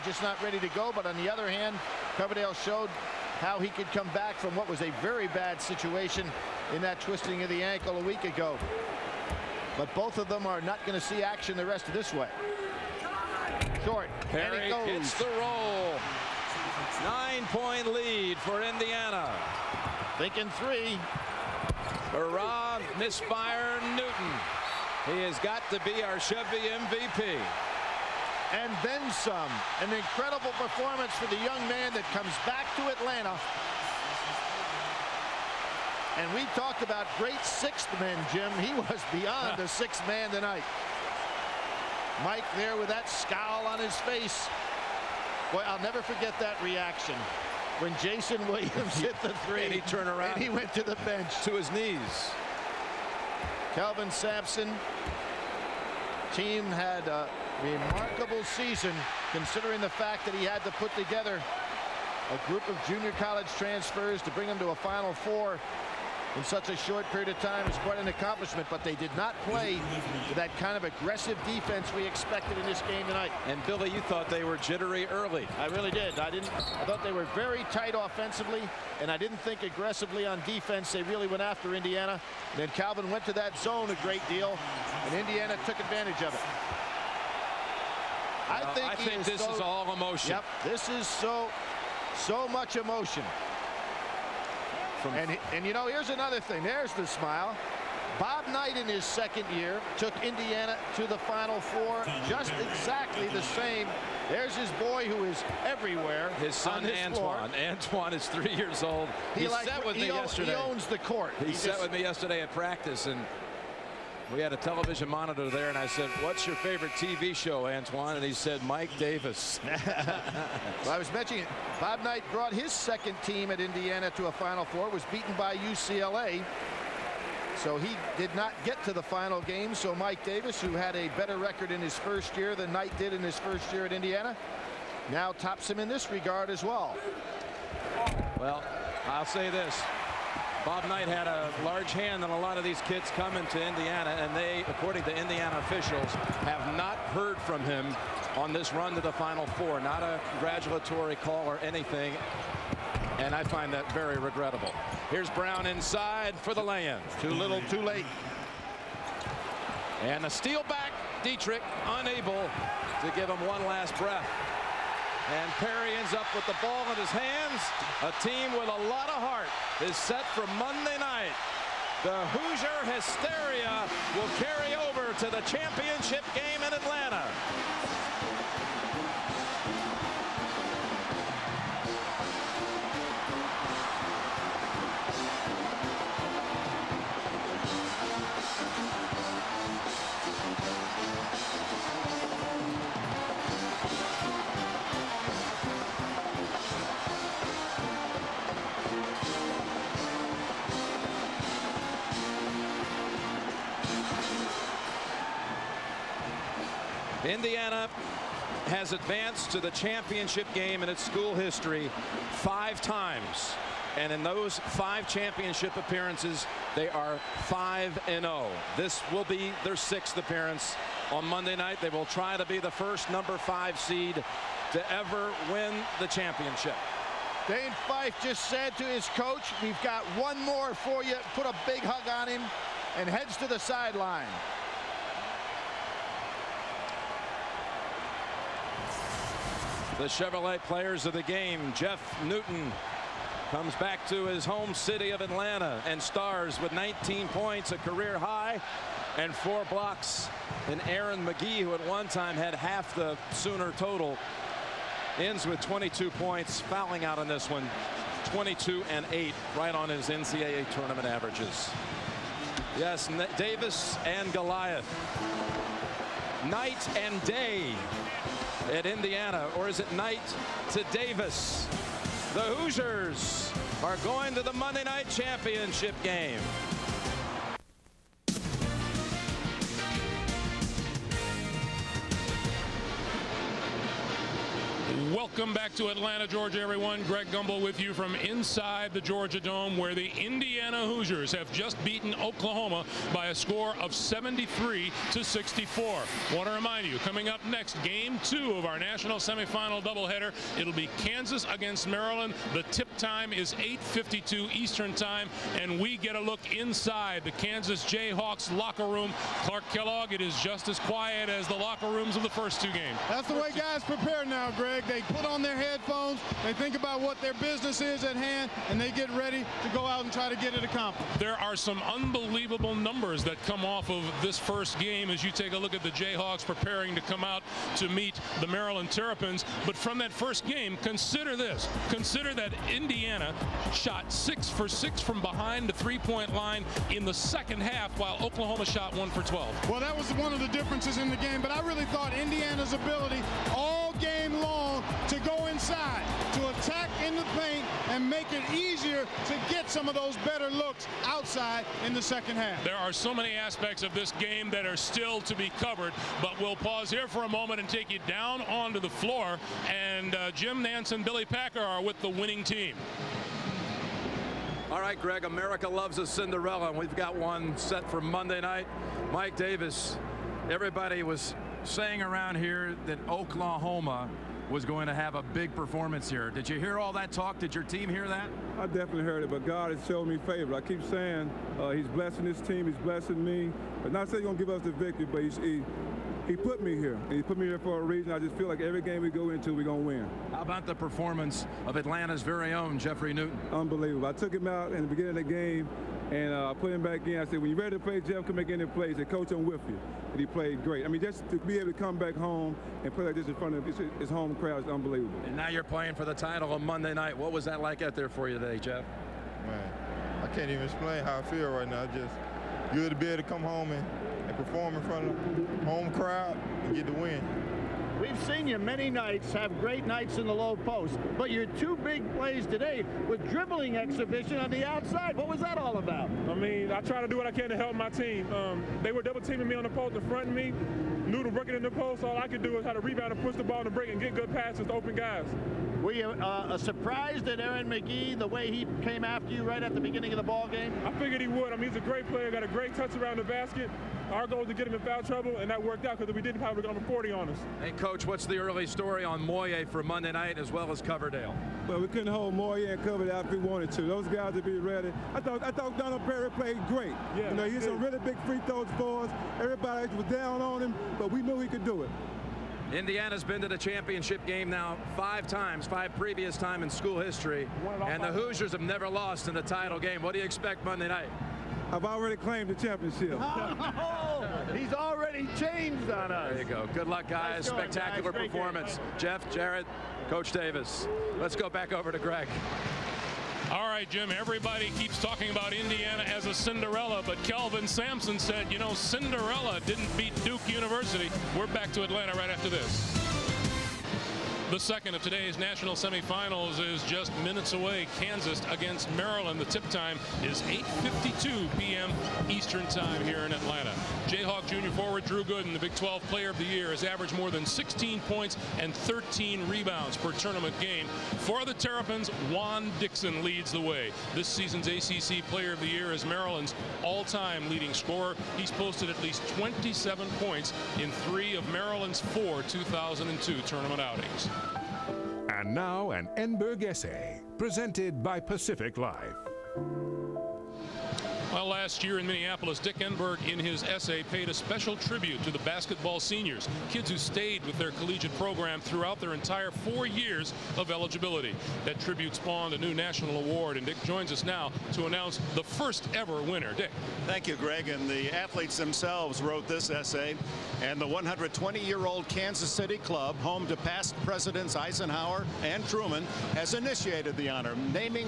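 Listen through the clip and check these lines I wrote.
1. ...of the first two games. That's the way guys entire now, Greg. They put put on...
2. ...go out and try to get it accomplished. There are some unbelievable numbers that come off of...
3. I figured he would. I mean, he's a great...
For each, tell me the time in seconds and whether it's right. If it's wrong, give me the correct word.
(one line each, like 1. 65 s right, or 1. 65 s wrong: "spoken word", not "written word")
1. 312 s wrong: "prepare", not "entire"
2. 319 s right
3. 440 s right.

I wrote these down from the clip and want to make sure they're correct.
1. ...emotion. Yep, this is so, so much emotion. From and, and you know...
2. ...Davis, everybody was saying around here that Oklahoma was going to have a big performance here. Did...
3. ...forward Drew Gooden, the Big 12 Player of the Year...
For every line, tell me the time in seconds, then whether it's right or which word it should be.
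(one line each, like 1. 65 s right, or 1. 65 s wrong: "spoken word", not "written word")
1. 89 s right
2. 369 s right
3. 504 s right.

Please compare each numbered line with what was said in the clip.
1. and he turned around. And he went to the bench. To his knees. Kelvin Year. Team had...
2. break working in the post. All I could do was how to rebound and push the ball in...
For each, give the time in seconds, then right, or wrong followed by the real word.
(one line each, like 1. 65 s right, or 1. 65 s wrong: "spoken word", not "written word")
1. 49 s wrong: "Sampson", not "Year"
2. 430 s right.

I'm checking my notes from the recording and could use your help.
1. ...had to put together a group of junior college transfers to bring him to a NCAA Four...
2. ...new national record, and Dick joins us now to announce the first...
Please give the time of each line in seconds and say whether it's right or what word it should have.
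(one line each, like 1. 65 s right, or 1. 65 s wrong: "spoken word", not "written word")
1. 60 s wrong: "Final", not "NCAA"
2. 542 s wrong: "award", not "record".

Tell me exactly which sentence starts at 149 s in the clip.
Not a congratulatory call or anything, and I find that very regrettable.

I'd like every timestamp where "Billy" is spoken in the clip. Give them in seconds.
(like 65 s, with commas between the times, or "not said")
73 s, 361 s.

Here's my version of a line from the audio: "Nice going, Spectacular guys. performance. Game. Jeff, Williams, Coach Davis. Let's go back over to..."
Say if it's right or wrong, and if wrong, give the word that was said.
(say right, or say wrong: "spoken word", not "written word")
wrong: "Jarrett", not "Williams".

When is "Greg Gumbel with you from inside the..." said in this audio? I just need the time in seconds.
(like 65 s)
287 s.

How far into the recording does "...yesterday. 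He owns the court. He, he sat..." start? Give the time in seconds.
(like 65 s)
110 s.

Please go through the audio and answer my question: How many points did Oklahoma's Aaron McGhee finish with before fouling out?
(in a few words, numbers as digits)
22.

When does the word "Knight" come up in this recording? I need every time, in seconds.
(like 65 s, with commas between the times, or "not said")
98 s, 122 s, 132 s, 140 s, 269 s.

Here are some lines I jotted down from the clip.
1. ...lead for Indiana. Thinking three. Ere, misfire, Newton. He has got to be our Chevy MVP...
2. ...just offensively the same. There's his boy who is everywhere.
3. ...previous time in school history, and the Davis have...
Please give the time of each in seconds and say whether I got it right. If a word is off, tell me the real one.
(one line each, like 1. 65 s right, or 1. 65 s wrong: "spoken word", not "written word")
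1. 17 s right
2. 102 s wrong: "exactly", not "offensively"
3. 465 s wrong: "Hoosiers", not "Davis".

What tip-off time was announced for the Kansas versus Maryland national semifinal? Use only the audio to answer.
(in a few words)
8.52 Eastern.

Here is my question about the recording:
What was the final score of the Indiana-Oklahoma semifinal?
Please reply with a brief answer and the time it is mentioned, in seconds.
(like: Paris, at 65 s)
73 to 64, at 293 s.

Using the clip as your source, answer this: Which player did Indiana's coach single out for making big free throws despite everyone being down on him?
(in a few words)
Donald Perry.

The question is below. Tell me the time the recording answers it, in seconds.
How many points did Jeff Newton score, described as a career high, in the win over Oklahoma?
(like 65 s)
246 s.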